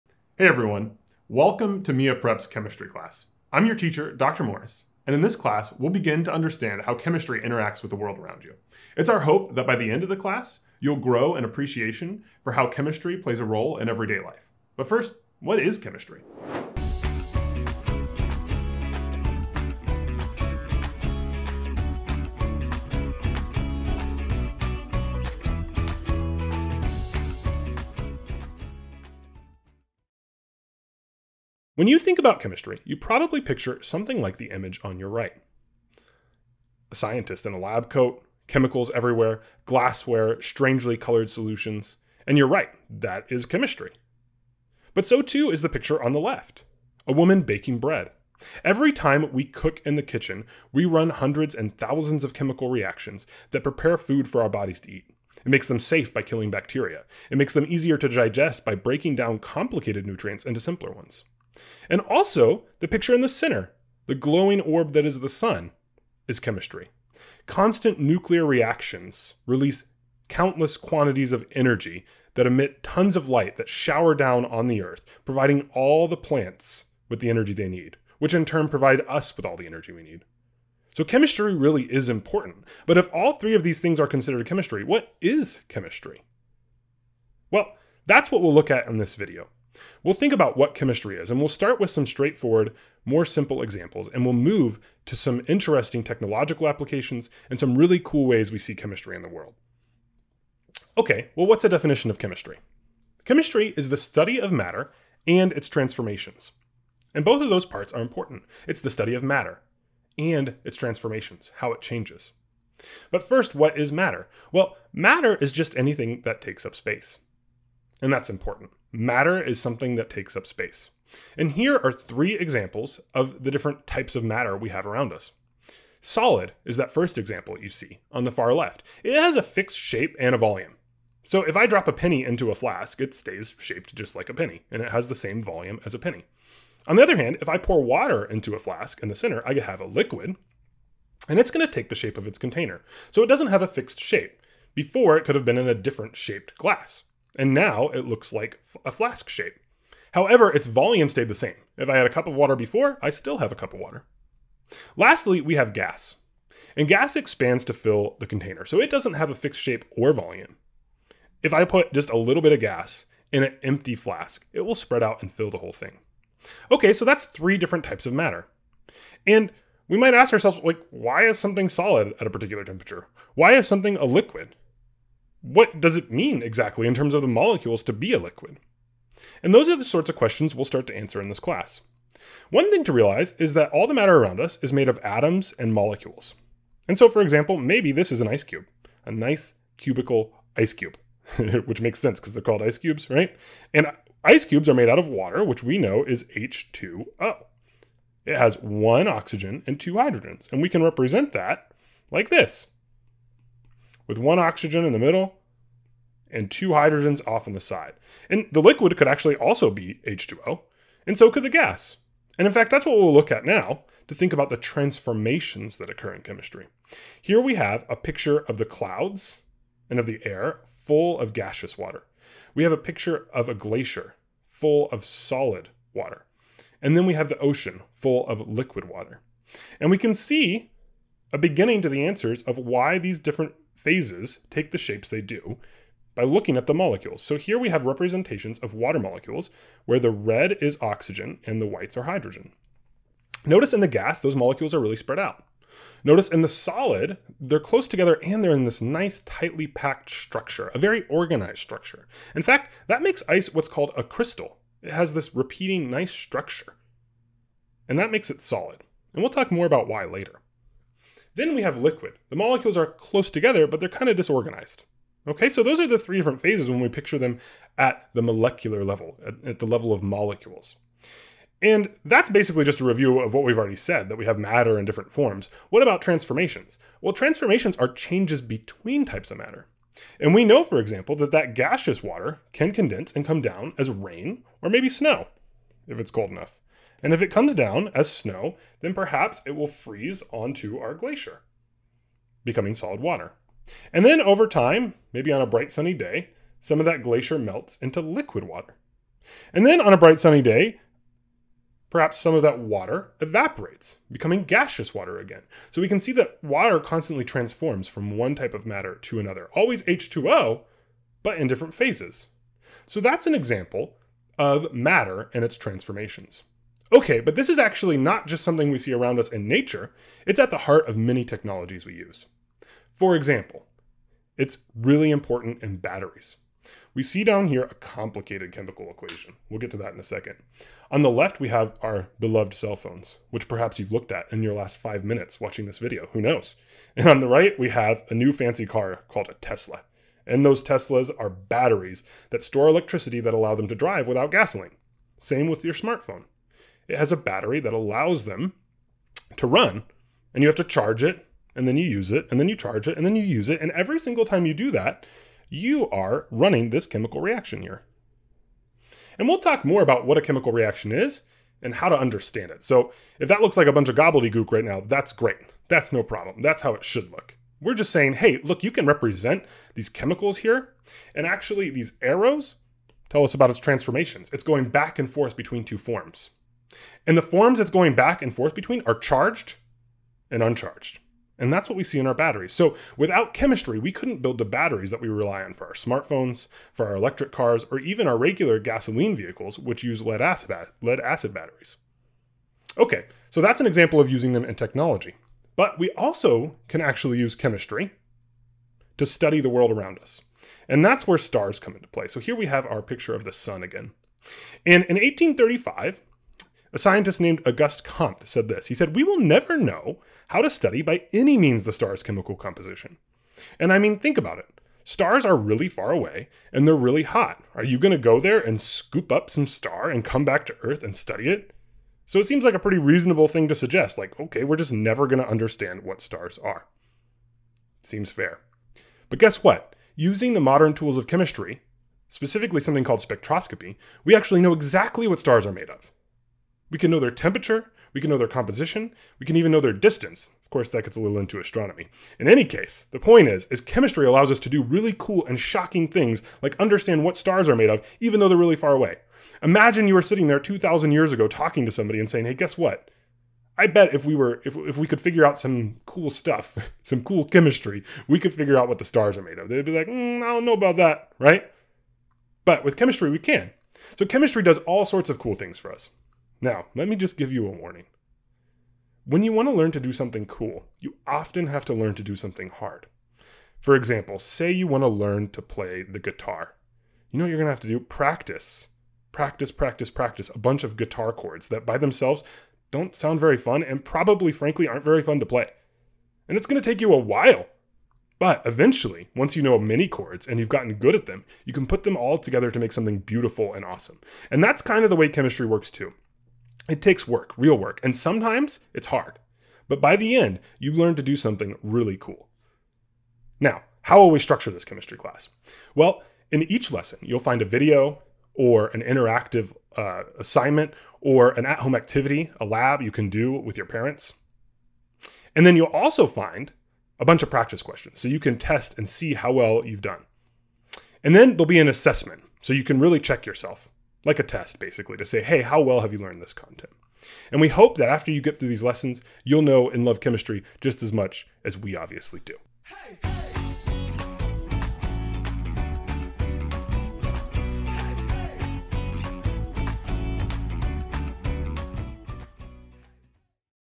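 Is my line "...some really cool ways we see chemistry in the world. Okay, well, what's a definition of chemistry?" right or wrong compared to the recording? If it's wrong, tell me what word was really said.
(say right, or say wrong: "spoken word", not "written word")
right.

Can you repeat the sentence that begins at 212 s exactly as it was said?
And in fact, that's what we'll look at now to think about the transformations that occur in chemistry.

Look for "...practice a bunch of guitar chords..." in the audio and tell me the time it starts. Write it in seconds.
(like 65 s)
479 s.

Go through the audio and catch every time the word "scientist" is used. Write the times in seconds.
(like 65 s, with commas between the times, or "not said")
36 s, 406 s.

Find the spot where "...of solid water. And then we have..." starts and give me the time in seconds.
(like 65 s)
224 s.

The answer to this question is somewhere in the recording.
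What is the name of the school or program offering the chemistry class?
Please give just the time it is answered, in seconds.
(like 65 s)
1 s.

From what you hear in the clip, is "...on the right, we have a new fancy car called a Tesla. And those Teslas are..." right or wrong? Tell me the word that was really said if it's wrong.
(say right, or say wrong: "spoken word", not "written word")
right.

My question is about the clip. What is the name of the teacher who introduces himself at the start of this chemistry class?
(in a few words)
Dr. Morris.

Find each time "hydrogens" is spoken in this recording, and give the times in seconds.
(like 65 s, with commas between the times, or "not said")
199 s, 206 s, 242 s.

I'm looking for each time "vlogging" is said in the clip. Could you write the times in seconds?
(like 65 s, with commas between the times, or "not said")
not said.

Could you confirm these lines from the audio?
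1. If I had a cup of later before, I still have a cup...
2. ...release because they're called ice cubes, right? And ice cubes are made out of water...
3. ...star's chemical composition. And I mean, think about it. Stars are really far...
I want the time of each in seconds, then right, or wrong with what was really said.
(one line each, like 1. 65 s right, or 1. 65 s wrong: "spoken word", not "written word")
1. 151 s wrong: "water", not "later"
2. 191 s wrong: "sense", not "release"
3. 411 s right.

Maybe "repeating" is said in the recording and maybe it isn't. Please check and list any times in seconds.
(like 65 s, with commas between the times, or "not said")
255 s.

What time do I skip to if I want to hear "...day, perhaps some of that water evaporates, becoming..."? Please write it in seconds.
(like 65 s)
300 s.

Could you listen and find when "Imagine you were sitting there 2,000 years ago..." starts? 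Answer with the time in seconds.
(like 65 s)
449 s.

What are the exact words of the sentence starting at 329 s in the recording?
We'll get to that in a second.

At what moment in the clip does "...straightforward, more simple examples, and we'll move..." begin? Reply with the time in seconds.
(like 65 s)
92 s.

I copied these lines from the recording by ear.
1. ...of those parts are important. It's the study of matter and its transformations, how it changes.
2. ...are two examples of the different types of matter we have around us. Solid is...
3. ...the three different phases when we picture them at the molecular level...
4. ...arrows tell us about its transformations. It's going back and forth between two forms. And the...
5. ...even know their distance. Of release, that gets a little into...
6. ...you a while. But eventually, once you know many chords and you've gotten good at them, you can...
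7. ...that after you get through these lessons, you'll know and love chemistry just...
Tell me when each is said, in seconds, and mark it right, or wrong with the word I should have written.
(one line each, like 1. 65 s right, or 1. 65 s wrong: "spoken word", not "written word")
1. 107 s right
2. 121 s wrong: "three", not "two"
3. 265 s right
4. 372 s right
5. 439 s wrong: "course", not "release"
6. 486 s right
7. 527 s right.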